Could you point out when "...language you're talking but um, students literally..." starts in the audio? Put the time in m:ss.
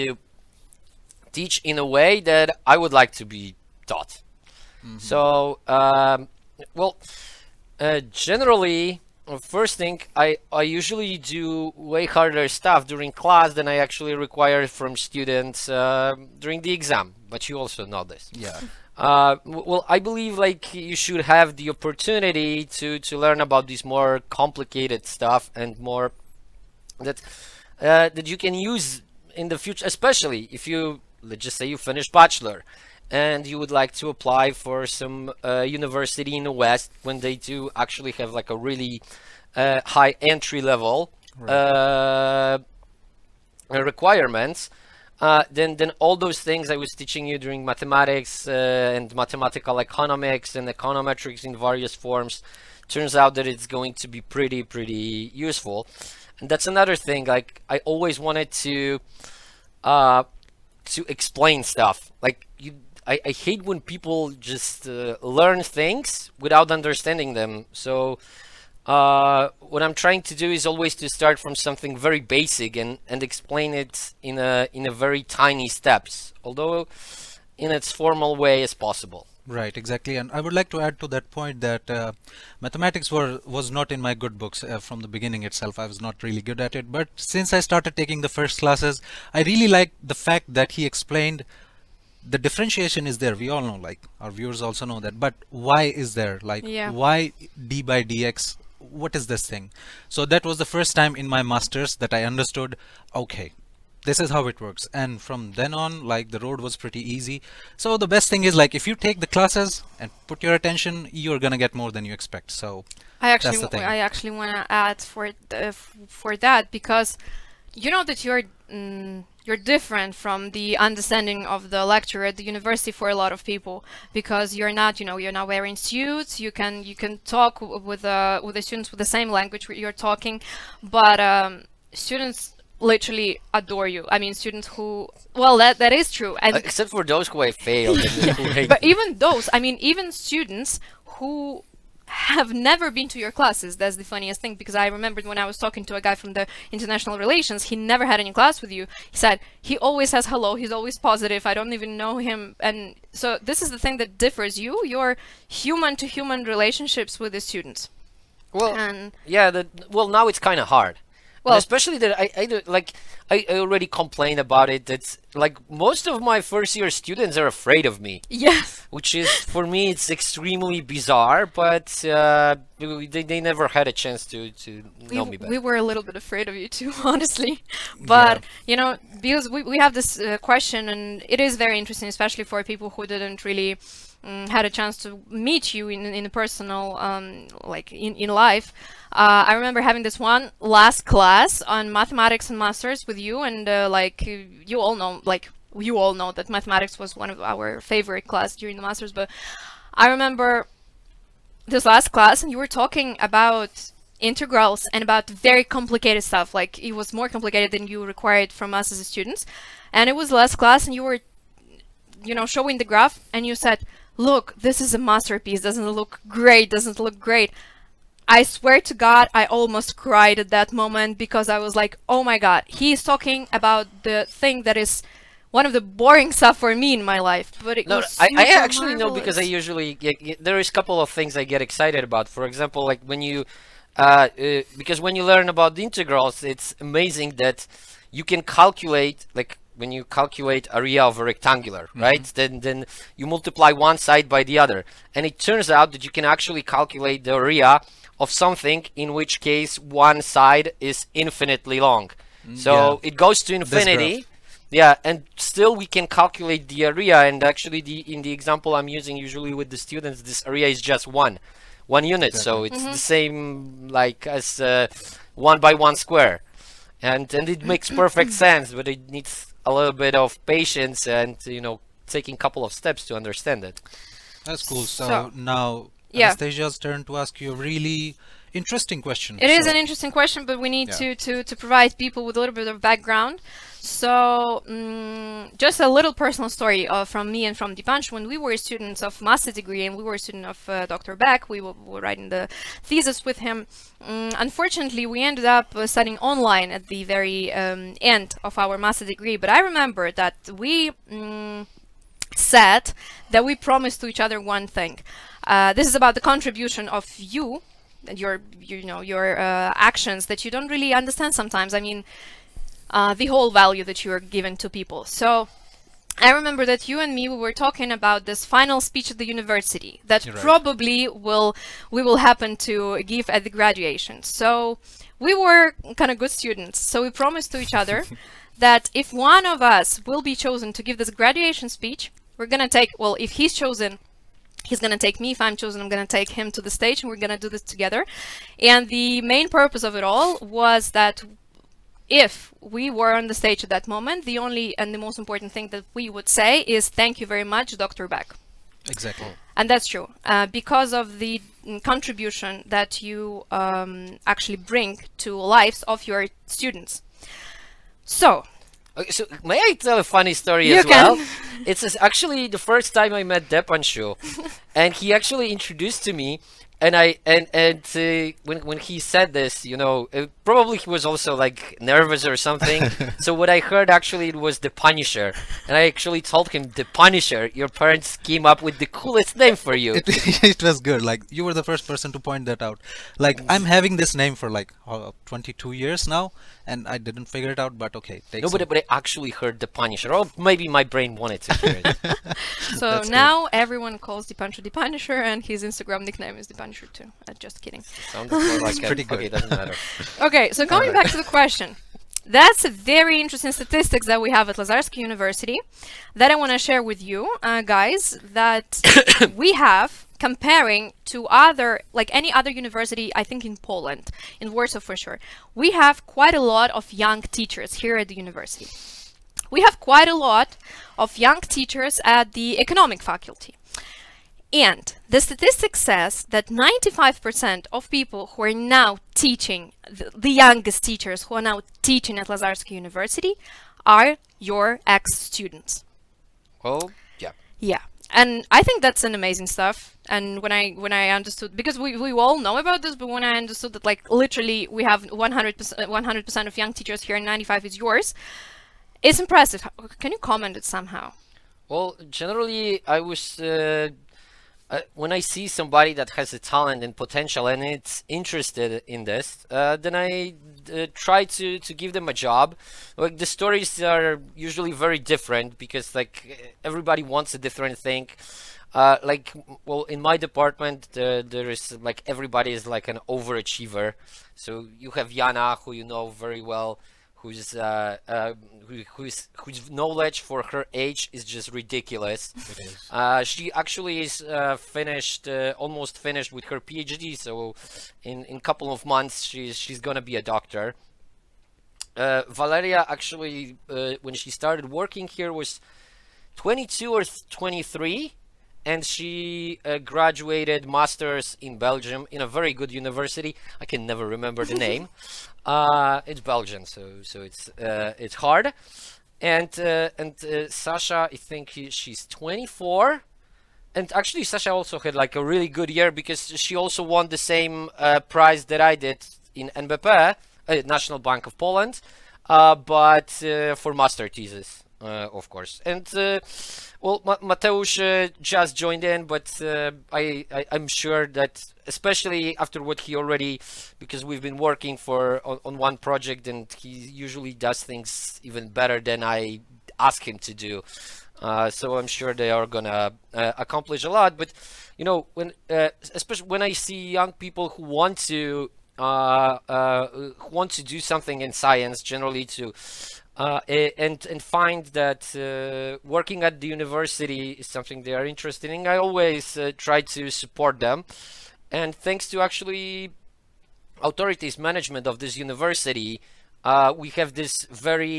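2:09.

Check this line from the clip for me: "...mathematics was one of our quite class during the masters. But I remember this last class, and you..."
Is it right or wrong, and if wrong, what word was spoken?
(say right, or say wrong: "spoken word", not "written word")
wrong: "favorite", not "quite".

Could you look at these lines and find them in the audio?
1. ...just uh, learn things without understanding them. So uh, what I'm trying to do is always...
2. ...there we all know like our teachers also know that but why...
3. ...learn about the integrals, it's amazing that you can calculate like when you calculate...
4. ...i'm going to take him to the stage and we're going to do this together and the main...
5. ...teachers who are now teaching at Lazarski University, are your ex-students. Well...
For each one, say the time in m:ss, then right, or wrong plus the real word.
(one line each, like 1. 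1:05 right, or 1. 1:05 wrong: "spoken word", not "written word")
1. 1:04 right
2. 1:33 wrong: "viewers", not "teachers"
3. 3:55 right
4. 5:35 right
5. 7:10 right.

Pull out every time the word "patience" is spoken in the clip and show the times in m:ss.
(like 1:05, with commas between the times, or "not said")
4:30.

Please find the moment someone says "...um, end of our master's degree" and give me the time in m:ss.
4:57.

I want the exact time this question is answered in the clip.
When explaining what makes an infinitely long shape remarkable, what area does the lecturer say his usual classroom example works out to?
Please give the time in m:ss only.
4:21.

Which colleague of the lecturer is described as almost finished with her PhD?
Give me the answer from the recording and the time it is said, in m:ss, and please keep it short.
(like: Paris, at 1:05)
Yana, at 7:55.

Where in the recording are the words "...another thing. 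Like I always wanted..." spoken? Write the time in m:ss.
0:56.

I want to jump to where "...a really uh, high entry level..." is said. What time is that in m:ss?
0:38.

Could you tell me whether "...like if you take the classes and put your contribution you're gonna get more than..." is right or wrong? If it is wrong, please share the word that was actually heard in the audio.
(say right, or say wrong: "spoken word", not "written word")
wrong: "attention", not "contribution".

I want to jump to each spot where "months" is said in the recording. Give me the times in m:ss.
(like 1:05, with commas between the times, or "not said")
8:08.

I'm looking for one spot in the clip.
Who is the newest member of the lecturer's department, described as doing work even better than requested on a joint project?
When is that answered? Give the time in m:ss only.
8:47.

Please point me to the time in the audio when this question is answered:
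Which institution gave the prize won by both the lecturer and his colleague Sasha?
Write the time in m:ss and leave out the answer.
8:40.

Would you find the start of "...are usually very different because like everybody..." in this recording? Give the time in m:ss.
7:43.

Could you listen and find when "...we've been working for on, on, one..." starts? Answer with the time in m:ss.
8:54.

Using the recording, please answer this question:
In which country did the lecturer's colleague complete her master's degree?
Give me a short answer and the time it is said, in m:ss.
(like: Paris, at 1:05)
Belgium, at 8:21.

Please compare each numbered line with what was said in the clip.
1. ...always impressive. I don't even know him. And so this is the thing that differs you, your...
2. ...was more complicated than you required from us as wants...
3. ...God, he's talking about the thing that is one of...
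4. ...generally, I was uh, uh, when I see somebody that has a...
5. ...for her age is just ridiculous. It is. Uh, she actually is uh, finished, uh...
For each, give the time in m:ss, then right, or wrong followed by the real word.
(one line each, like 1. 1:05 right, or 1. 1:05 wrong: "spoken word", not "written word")
1. 2:30 wrong: "positive", not "impressive"
2. 3:26 wrong: "students", not "wants"
3. 3:42 right
4. 7:32 right
5. 8:00 right.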